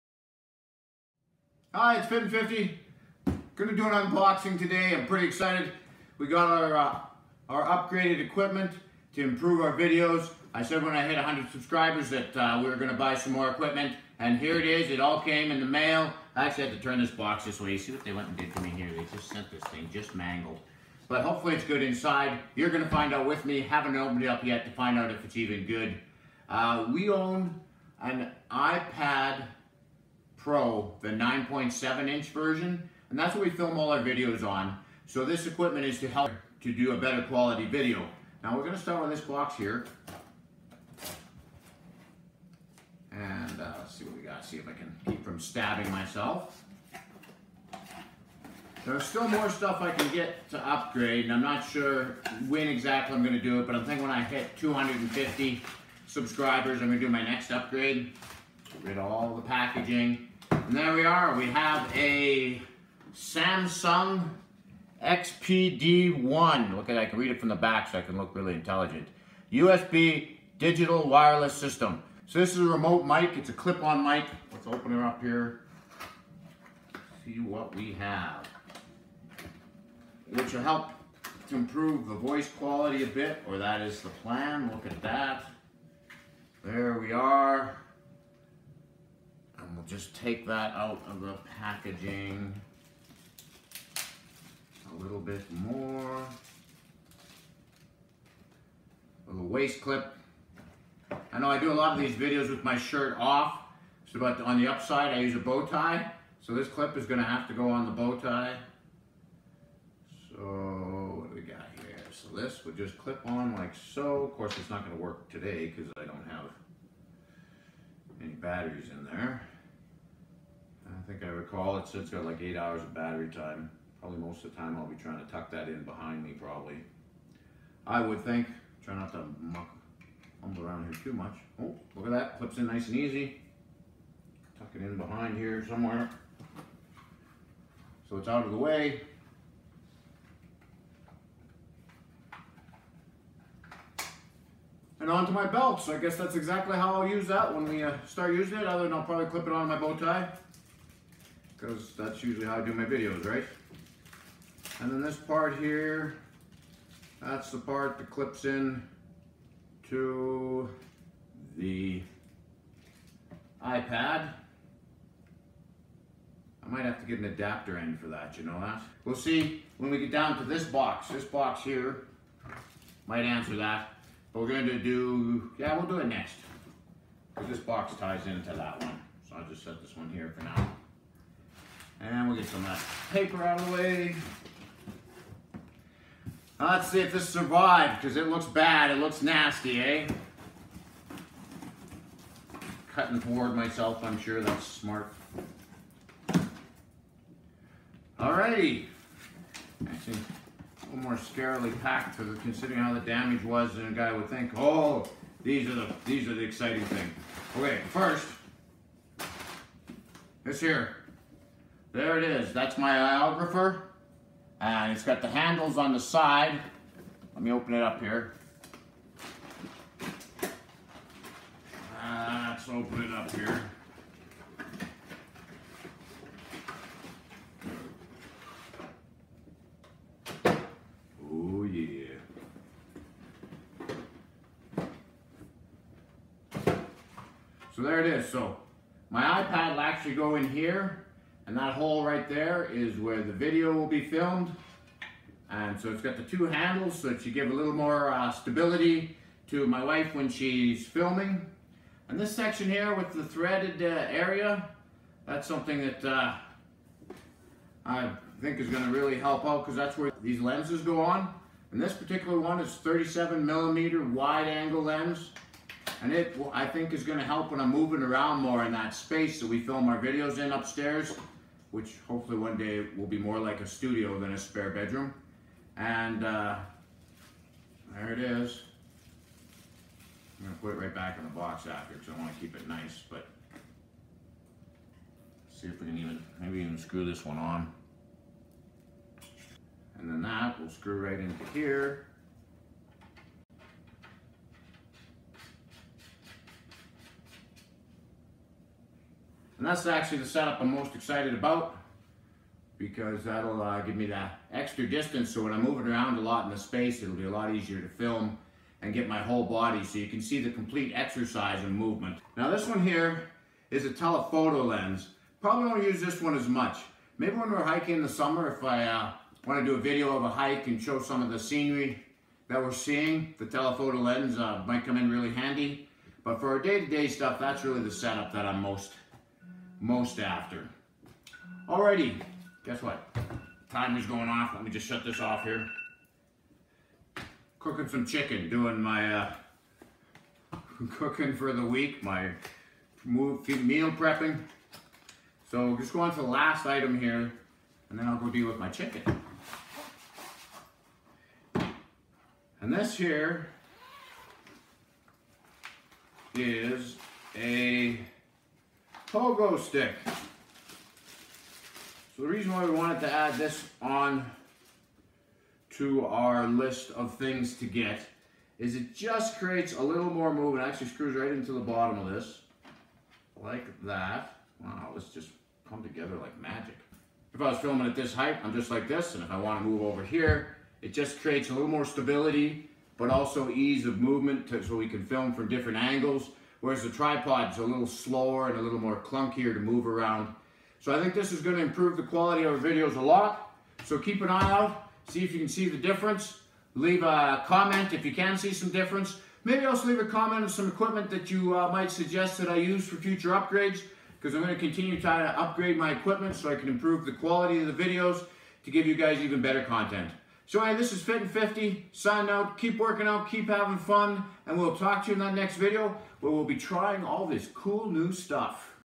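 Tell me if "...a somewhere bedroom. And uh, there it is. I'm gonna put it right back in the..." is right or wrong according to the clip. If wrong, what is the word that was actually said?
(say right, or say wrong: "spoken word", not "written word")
wrong: "spare", not "somewhere".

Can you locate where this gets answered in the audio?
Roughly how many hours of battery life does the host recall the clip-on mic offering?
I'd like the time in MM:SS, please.
02:02.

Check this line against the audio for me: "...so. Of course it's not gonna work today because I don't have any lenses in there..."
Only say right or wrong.
wrong.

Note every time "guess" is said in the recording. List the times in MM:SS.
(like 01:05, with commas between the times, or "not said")
02:25, 05:32.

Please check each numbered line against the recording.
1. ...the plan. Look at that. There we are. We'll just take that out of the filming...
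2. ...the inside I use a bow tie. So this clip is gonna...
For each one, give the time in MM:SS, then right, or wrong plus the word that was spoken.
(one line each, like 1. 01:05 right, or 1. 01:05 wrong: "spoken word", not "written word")
1. 01:24 wrong: "packaging", not "filming"
2. 01:44 wrong: "upside", not "inside".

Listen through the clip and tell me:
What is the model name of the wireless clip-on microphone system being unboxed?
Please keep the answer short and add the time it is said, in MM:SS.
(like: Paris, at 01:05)
Samson XPD1, at 01:03.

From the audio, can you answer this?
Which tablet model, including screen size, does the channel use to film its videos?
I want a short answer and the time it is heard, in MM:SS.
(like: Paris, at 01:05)
iPad Pro 9.7 inch, at 00:28.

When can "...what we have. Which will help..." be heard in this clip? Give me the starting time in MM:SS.
01:17.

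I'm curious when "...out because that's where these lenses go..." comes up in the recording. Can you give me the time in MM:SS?
04:19.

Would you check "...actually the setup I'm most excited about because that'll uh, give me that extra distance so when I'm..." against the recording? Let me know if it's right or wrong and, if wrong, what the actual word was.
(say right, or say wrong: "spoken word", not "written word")
right.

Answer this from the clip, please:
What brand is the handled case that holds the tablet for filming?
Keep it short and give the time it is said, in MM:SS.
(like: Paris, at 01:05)
iOgrapher, at 03:32.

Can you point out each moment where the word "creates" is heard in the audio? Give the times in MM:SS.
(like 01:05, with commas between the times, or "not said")
06:09, 06:21.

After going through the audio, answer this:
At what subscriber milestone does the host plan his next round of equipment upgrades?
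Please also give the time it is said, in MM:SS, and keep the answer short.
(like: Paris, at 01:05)
250, at 00:54.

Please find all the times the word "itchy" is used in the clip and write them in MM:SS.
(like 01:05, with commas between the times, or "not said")
not said.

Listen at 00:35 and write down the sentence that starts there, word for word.
So this equipment is to help to do a better quality video.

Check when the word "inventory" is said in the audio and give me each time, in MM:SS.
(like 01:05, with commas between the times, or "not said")
not said.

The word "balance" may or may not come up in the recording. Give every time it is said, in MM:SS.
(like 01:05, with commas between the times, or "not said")
not said.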